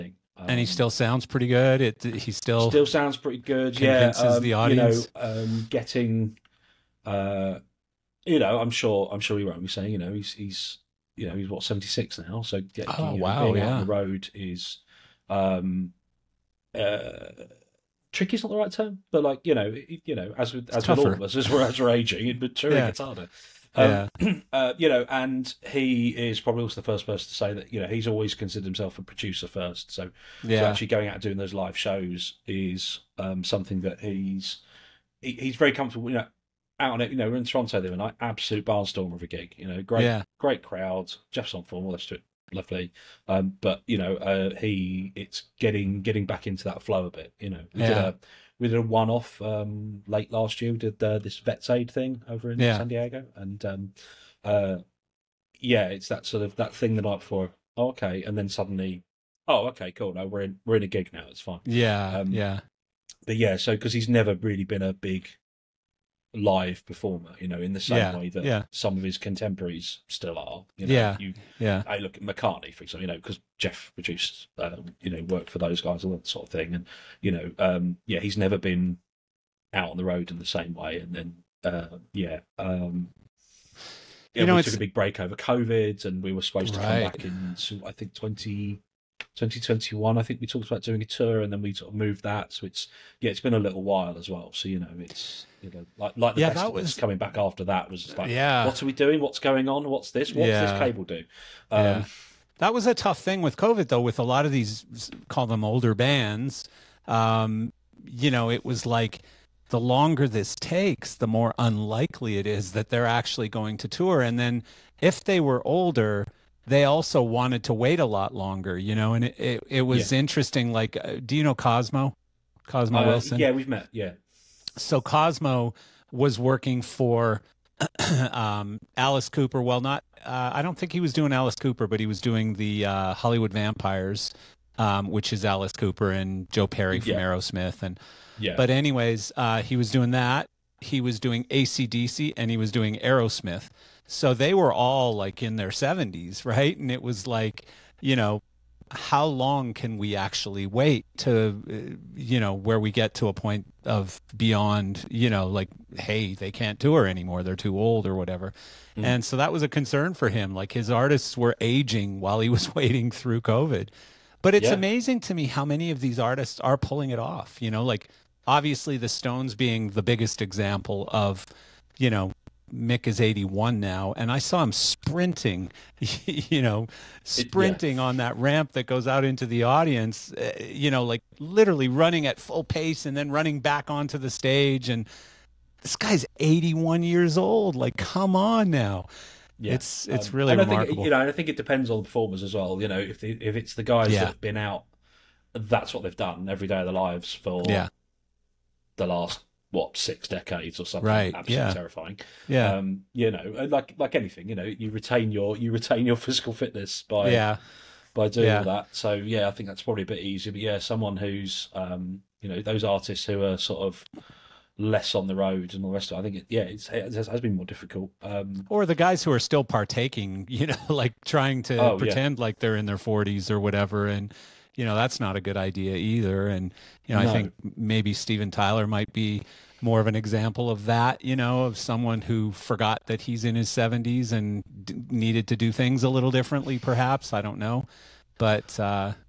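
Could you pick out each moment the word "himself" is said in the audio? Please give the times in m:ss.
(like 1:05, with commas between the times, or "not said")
0:28.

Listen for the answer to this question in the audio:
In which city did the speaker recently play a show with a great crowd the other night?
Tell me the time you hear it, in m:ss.
0:37.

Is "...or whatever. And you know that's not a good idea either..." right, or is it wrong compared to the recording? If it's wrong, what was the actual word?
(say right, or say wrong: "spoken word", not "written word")
right.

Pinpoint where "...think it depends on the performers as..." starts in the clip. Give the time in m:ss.
3:11.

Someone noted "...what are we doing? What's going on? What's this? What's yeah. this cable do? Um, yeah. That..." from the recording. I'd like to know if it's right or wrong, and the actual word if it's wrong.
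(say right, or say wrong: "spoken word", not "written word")
right.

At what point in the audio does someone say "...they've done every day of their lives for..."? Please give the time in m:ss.
3:16.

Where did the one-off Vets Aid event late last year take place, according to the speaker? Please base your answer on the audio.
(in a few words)
San Diego.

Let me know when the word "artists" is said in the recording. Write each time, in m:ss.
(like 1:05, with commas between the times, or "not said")
2:40, 2:46, 3:32.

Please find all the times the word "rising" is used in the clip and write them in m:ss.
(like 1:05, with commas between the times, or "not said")
not said.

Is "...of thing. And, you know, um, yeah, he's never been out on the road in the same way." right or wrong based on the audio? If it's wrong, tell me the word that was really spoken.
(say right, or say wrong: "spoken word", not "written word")
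right.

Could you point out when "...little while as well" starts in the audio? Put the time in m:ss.
1:33.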